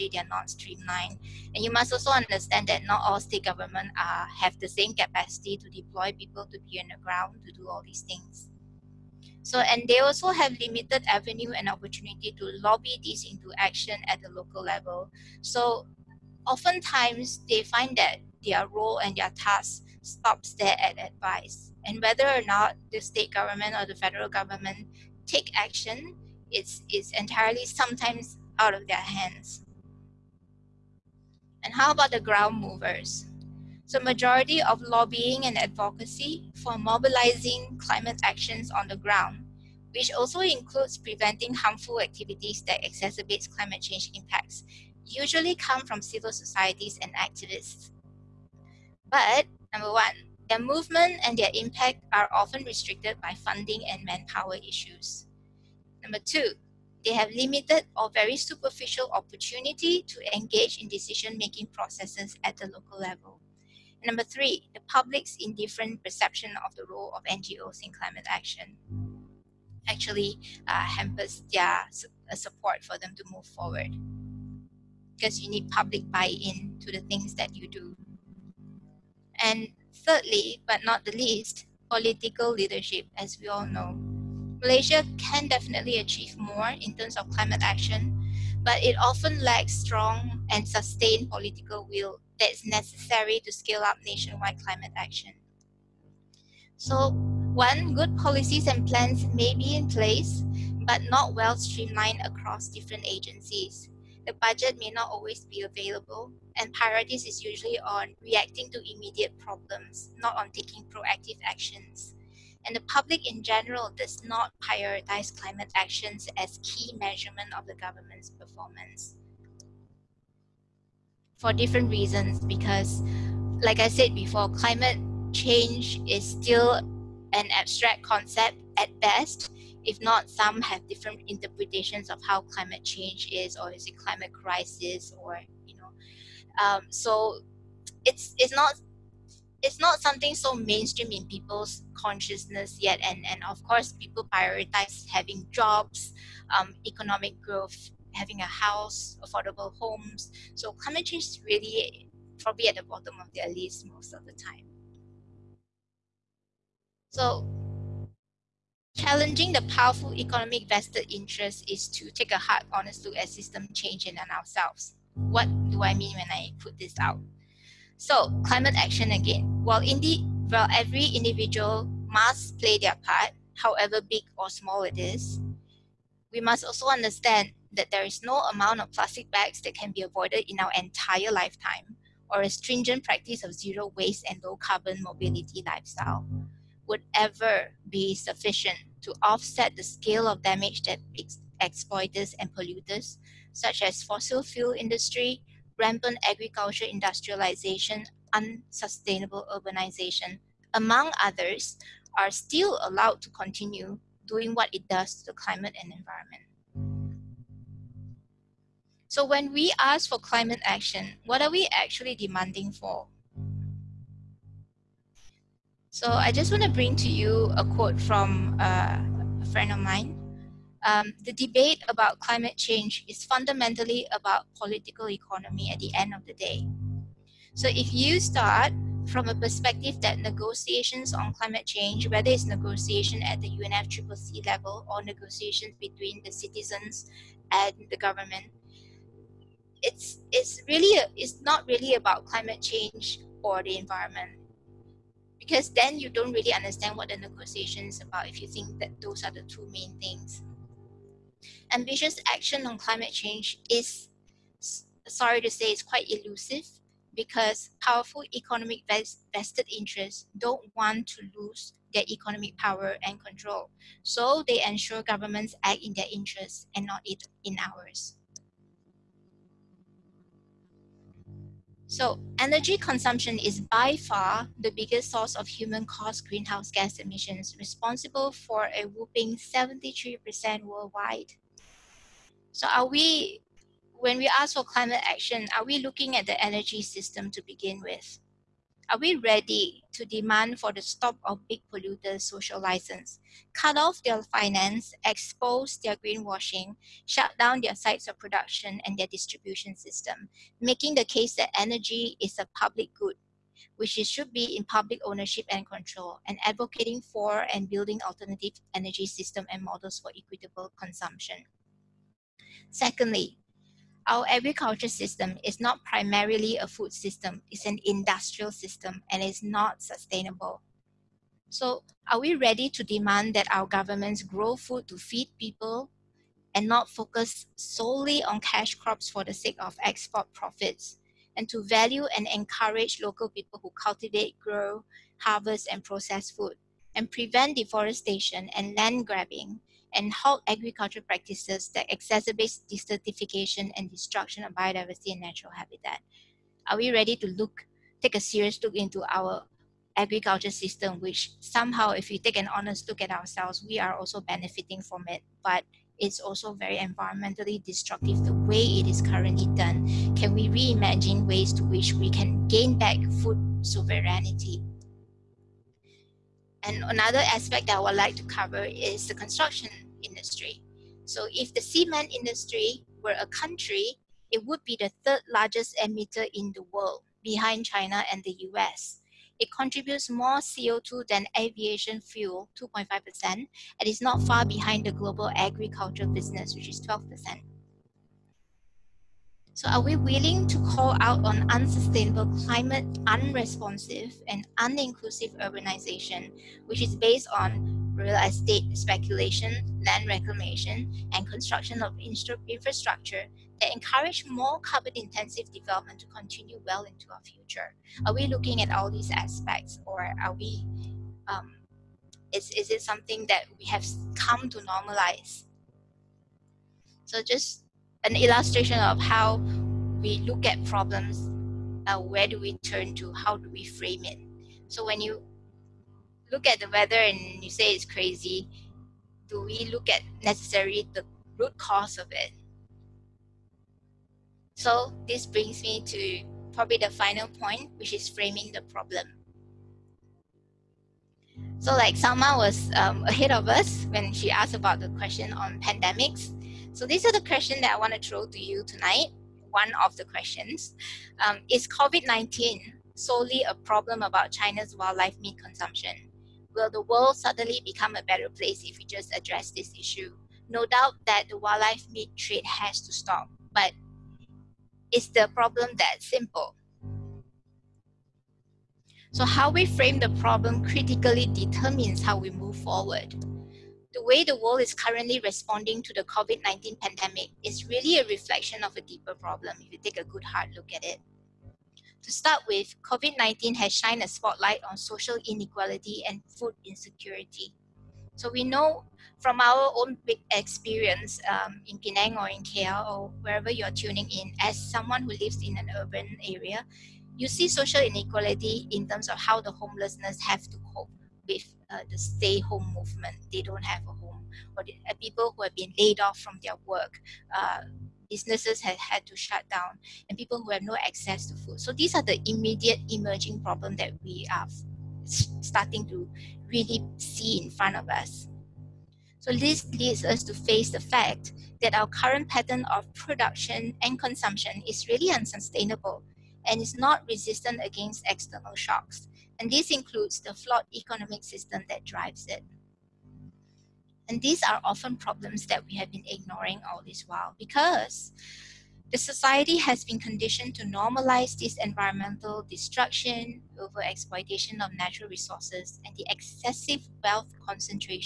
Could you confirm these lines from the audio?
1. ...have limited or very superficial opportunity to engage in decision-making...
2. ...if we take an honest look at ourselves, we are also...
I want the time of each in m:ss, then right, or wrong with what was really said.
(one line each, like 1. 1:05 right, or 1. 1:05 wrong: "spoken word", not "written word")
1. 0:57 right
2. 5:51 right.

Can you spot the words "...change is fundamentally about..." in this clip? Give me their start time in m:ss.
3:42.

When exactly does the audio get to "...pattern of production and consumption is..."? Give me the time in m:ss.
8:42.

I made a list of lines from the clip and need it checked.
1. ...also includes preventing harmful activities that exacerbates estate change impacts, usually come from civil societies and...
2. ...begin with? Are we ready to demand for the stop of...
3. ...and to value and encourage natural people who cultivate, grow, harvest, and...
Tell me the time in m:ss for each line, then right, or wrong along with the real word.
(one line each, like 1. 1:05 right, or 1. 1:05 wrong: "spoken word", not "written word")
1. 0:40 wrong: "climate", not "estate"
2. 4:47 right
3. 5:31 wrong: "local", not "natural".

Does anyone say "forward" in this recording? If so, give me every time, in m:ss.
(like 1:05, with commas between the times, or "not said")
1:13, 7:52.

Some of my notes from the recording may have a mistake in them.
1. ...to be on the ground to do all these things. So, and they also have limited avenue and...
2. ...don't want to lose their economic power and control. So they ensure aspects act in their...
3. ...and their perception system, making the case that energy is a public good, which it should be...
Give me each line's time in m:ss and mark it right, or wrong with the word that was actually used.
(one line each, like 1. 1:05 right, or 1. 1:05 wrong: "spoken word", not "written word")
1. 0:06 right
2. 4:20 wrong: "governments", not "aspects"
3. 4:58 wrong: "distribution", not "perception".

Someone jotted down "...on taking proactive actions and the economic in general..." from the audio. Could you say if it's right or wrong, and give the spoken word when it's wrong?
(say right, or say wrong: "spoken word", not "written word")
wrong: "public", not "economic".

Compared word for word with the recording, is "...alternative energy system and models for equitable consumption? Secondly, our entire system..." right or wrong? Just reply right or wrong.
wrong.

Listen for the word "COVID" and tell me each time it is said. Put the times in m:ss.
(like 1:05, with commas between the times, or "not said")
7:31, 7:56, 8:02.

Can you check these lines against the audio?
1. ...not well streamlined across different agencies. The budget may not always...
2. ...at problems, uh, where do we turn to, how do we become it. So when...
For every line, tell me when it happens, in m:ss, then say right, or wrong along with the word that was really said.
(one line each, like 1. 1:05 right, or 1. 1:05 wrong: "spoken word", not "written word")
1. 1:41 right
2. 7:00 wrong: "frame", not "become".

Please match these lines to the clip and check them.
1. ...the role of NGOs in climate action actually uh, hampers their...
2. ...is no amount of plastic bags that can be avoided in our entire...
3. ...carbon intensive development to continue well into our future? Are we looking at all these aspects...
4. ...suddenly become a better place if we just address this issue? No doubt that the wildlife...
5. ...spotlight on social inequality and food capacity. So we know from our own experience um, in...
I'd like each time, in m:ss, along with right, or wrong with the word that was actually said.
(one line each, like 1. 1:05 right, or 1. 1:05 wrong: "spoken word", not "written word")
1. 1:06 right
2. 2:58 right
3. 6:44 right
4. 7:37 right
5. 8:04 wrong: "insecurity", not "capacity".